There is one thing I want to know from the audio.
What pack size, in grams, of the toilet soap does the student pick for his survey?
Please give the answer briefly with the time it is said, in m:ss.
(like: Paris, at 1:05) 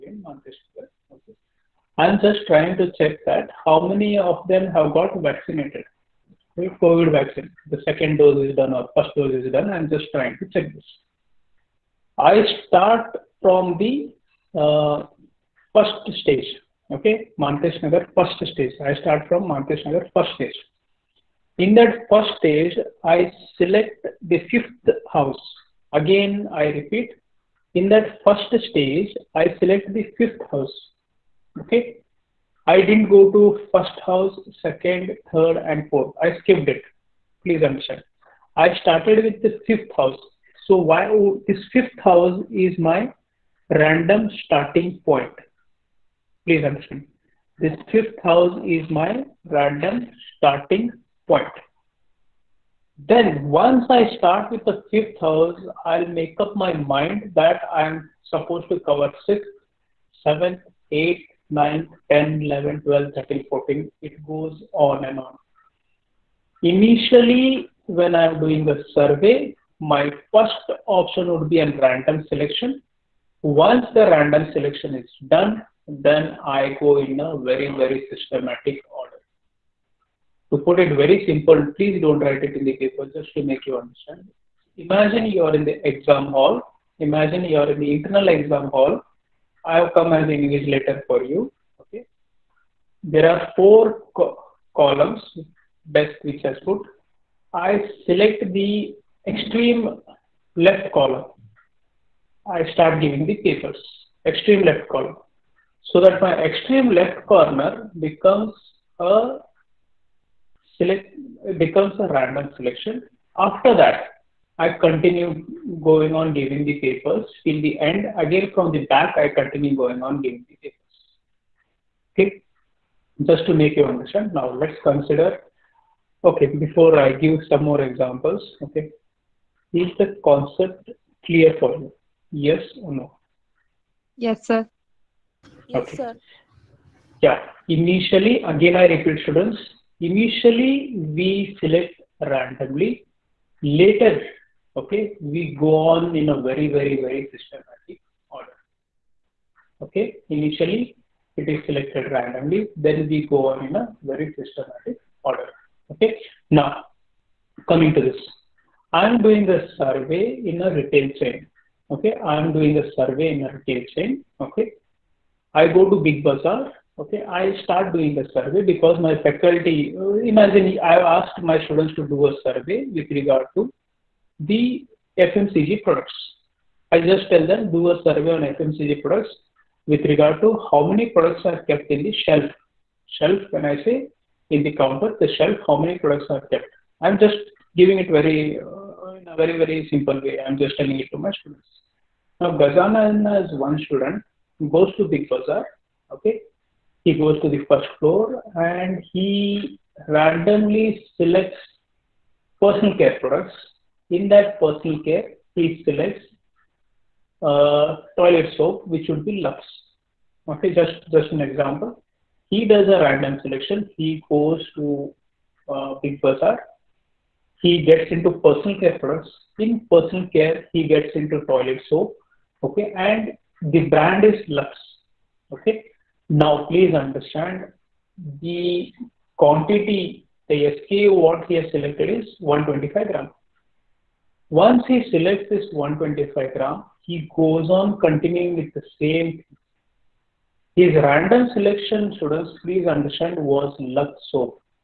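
125 grams, at 3:52.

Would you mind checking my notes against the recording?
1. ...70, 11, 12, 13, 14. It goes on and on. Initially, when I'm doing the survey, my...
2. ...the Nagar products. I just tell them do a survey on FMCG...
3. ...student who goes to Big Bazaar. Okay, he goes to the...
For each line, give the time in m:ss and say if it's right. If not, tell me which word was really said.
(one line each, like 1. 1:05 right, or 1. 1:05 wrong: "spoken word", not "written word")
1. 1:02 wrong: "10", not "70"
2. 2:54 wrong: "FMCG", not "Nagar"
3. 3:13 right.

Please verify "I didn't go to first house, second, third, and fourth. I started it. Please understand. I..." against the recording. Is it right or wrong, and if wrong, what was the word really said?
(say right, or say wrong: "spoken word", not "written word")
wrong: "skipped", not "started".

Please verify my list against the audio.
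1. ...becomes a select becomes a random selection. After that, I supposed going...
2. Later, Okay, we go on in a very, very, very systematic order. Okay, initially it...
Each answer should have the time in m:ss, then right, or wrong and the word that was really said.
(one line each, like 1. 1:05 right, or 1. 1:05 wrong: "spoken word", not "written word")
1. 1:47 wrong: "continued", not "supposed"
2. 2:23 right.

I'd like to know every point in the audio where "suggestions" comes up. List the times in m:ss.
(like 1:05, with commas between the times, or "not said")
not said.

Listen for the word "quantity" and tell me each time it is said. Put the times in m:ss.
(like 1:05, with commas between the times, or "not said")
3:49.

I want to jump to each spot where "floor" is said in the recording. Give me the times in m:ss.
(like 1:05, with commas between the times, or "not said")
3:17.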